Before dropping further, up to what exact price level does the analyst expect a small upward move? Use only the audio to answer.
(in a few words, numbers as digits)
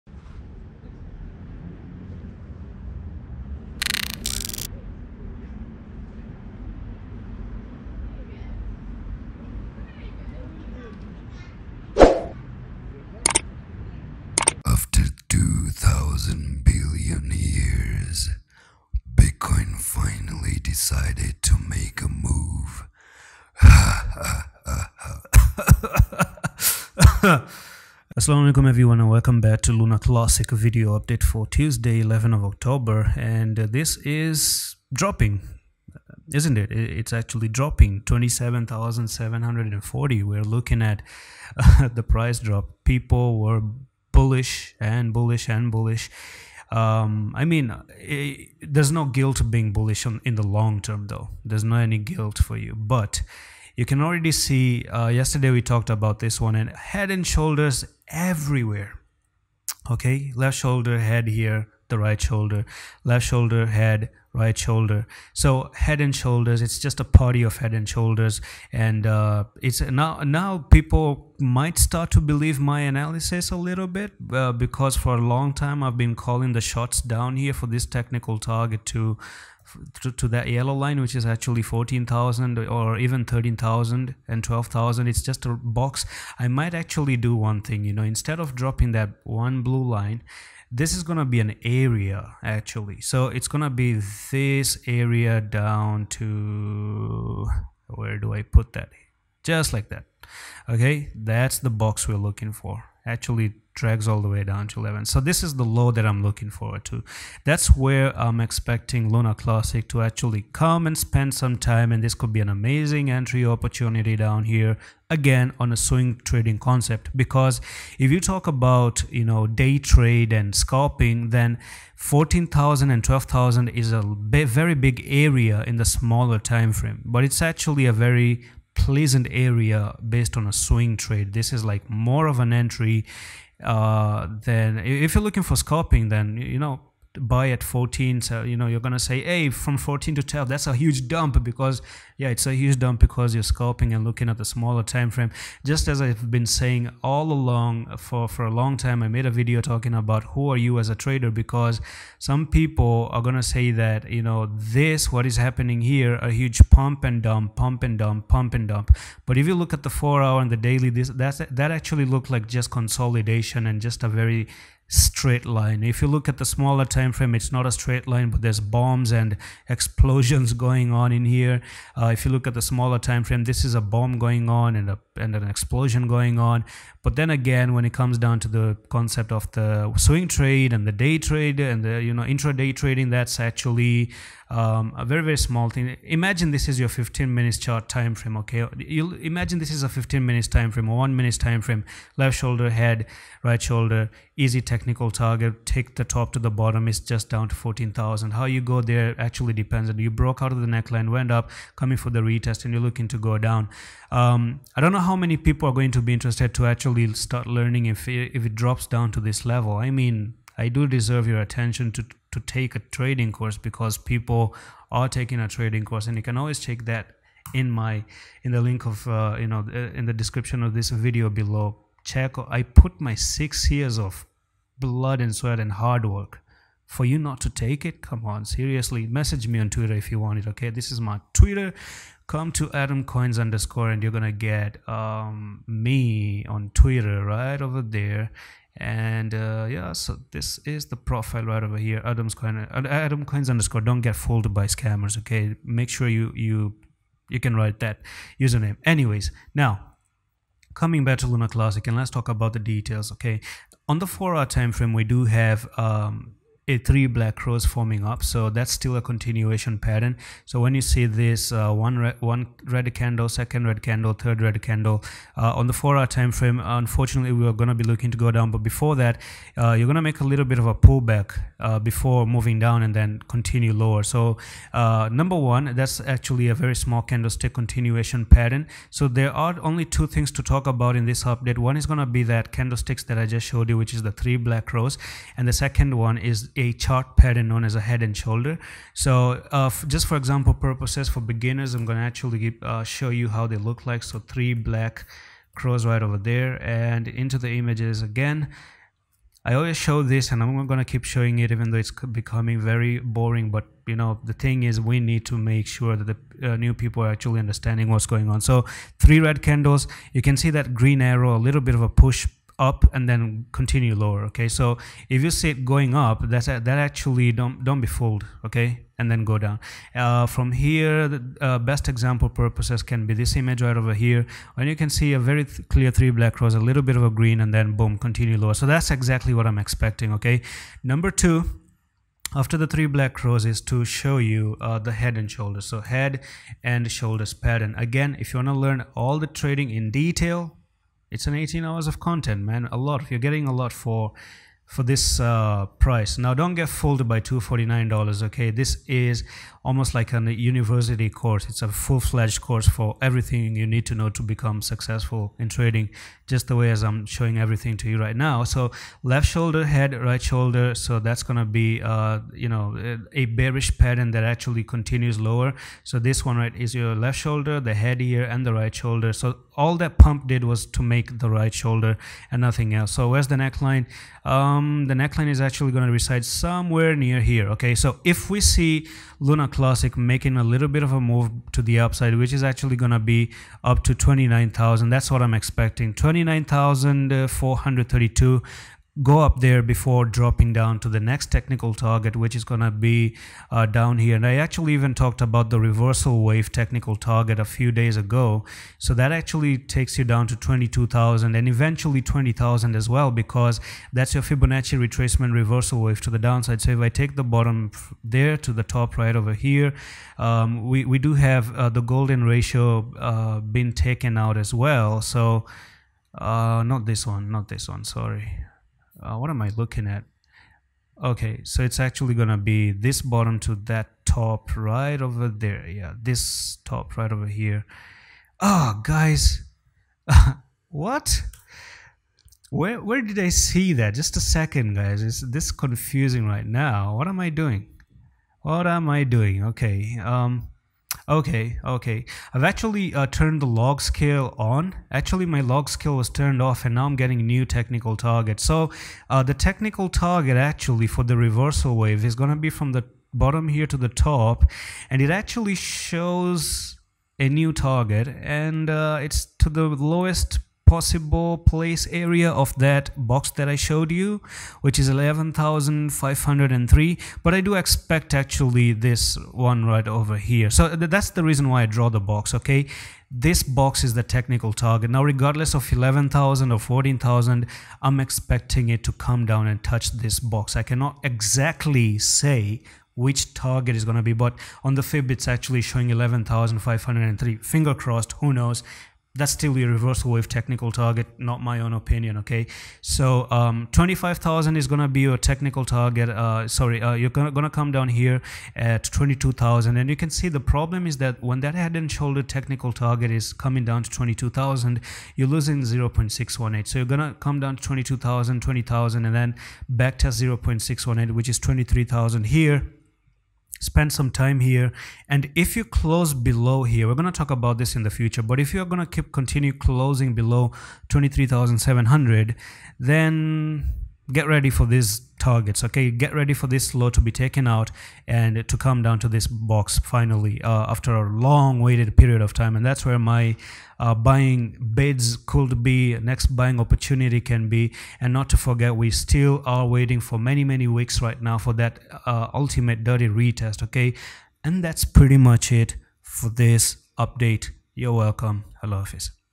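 29432.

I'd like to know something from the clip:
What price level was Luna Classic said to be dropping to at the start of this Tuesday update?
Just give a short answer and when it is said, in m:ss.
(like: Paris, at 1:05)
27,740, at 0:38.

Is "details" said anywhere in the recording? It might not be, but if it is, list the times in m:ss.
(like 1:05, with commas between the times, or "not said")
4:12, 5:40.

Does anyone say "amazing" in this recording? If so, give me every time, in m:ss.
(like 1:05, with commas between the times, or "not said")
1:52.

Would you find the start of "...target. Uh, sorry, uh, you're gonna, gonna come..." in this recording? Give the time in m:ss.
8:15.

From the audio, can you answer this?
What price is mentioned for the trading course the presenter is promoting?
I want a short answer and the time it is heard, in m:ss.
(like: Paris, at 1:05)
$249, at 5:47.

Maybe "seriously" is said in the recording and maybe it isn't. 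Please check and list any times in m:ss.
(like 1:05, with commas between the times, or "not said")
3:48.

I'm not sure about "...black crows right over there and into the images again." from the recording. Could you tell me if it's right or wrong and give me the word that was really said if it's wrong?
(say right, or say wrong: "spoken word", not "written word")
right.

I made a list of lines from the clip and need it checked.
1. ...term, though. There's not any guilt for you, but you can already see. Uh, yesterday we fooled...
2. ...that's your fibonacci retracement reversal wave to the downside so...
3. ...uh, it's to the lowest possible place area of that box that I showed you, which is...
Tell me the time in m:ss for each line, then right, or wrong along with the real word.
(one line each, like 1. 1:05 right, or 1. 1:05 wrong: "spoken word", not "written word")
1. 0:50 wrong: "talked", not "fooled"
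2. 6:43 right
3. 7:38 right.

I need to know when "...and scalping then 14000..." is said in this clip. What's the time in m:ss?
2:00.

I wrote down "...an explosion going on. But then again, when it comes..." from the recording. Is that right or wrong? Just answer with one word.
right.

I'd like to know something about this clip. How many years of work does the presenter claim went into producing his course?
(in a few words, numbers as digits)
six years.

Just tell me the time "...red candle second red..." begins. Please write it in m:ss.
4:22.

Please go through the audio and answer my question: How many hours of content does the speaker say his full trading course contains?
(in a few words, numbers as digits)
18 hours.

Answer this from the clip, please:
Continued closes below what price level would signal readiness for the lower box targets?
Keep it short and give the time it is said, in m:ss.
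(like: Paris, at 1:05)
23700, at 8:40.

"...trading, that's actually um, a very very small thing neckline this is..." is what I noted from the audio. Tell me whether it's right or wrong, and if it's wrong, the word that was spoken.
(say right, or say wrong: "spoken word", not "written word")
wrong: "imagine", not "neckline".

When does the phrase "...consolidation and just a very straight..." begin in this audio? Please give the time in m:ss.
2:42.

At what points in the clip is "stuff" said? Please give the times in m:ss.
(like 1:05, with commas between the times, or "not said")
not said.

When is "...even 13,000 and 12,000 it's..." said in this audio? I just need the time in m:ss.
1:22.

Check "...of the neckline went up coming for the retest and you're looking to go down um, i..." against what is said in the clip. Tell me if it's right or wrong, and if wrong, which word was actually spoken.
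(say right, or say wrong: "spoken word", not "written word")
right.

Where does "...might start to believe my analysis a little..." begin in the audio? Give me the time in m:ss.
1:11.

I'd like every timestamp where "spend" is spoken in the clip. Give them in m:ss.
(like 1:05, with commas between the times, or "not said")
1:50, 8:33.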